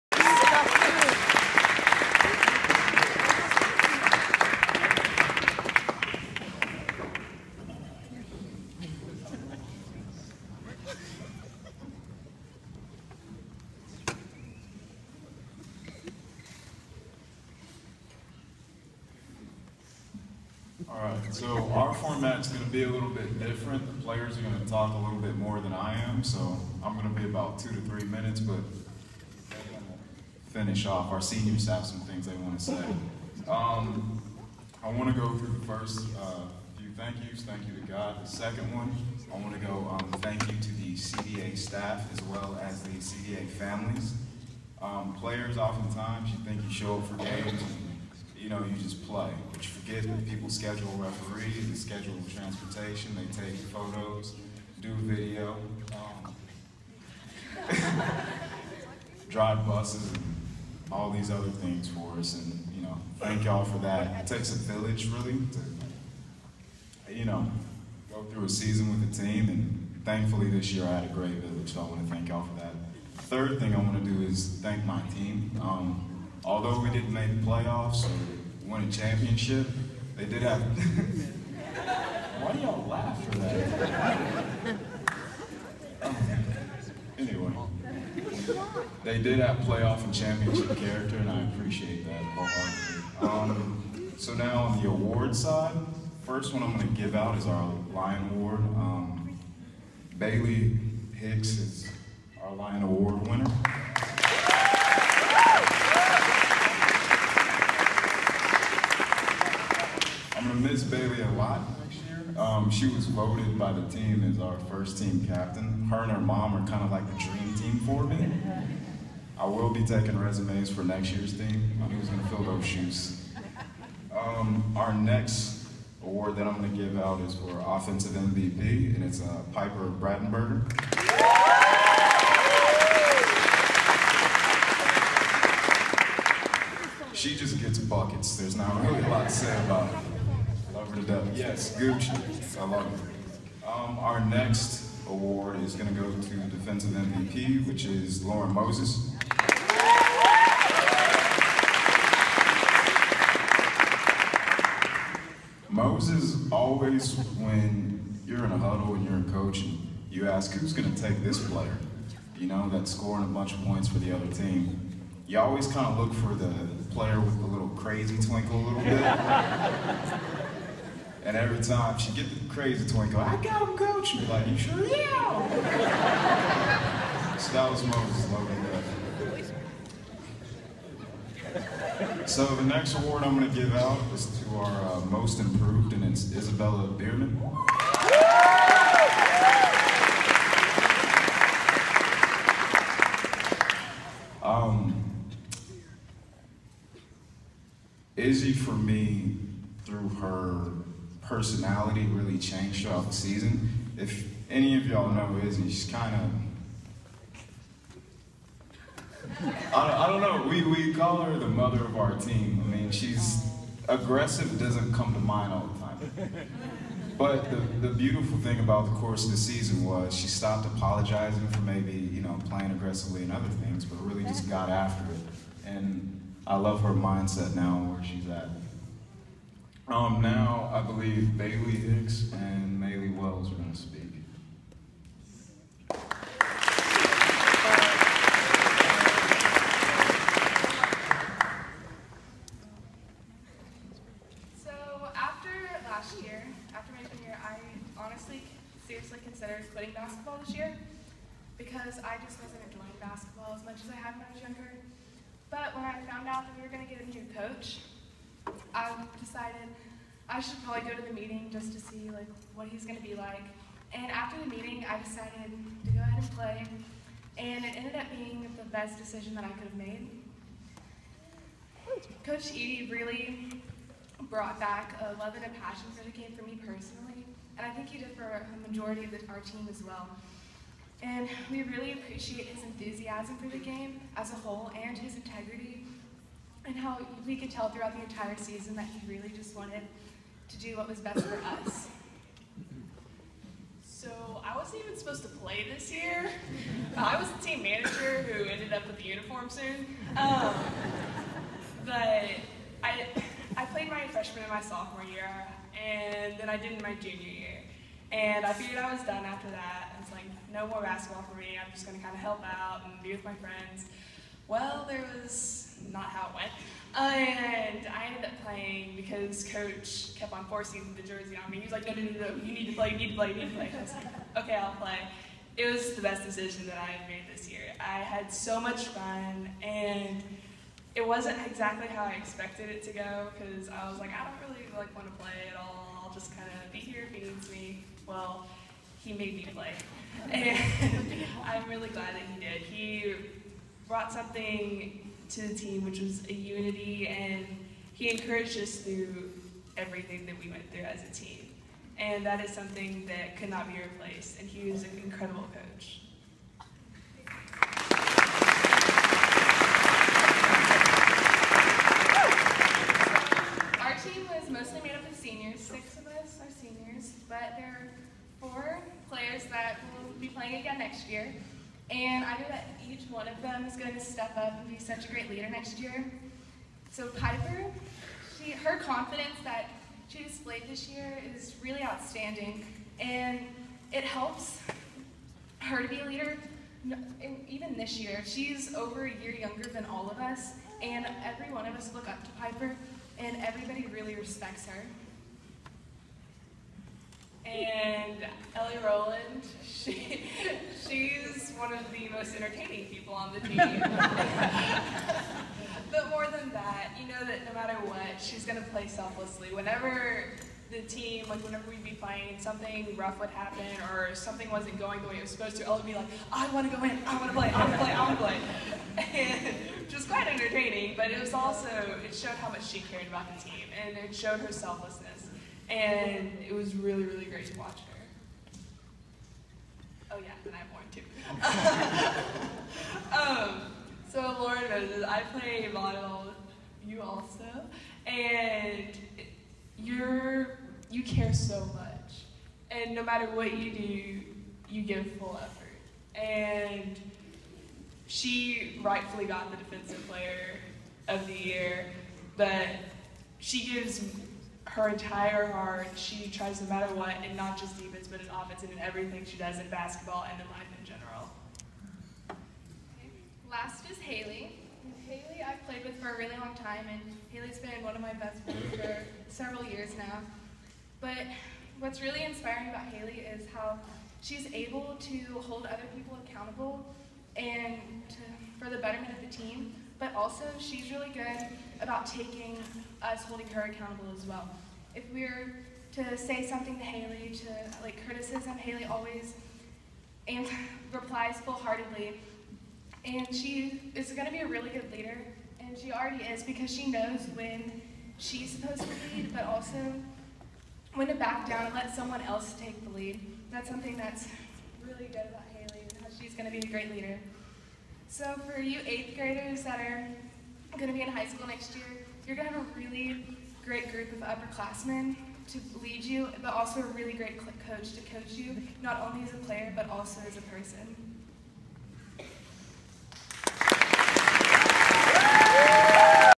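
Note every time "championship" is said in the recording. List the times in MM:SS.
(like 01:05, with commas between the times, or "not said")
01:18, 01:30.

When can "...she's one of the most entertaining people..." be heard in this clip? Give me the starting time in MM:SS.
06:40.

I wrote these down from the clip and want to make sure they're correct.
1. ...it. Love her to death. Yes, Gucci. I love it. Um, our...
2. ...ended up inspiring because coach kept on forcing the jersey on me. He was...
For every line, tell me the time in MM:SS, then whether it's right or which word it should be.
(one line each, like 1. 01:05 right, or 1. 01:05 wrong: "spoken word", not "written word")
1. 02:19 right
2. 05:18 wrong: "playing", not "inspiring".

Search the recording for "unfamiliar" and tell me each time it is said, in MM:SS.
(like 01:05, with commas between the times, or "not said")
not said.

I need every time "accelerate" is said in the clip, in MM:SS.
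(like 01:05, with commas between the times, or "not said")
not said.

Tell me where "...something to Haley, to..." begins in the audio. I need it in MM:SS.
08:06.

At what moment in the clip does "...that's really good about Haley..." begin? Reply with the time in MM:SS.
08:23.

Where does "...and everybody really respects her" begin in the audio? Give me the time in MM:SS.
06:33.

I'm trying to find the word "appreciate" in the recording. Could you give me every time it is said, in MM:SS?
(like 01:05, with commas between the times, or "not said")
01:31, 04:41.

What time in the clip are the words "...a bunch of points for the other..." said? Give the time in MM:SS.
02:43.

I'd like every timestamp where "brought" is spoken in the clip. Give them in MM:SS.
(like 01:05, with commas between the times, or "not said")
04:34, 05:43.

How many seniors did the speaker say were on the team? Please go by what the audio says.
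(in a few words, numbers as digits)
6.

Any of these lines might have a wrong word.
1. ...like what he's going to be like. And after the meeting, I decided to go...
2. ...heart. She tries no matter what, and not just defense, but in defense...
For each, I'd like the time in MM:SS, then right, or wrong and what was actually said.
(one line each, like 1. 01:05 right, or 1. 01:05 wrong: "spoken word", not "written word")
1. 04:22 right
2. 07:35 wrong: "offense", not "defense".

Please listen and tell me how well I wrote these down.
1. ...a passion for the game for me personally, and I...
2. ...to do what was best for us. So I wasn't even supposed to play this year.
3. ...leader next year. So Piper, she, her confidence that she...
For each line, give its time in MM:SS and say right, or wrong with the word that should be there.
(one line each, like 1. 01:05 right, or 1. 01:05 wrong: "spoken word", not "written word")
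1. 04:35 right
2. 04:50 right
3. 06:15 right.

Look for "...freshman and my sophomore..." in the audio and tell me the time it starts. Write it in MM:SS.
05:04.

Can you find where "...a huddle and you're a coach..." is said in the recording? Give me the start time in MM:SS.
02:38.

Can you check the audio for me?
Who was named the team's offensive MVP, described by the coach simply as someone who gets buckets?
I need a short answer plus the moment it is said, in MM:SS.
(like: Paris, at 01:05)
Piper Brattenberger, at 02:09.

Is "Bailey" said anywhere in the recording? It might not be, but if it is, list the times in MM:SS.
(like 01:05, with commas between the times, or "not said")
01:40, 03:51.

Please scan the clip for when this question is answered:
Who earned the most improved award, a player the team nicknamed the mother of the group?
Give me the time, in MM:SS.
03:06.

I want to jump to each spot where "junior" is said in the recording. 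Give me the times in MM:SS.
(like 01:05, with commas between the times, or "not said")
04:07, 05:06.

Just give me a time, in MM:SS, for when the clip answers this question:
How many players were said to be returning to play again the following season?
06:08.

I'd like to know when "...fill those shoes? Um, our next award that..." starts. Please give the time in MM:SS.
02:02.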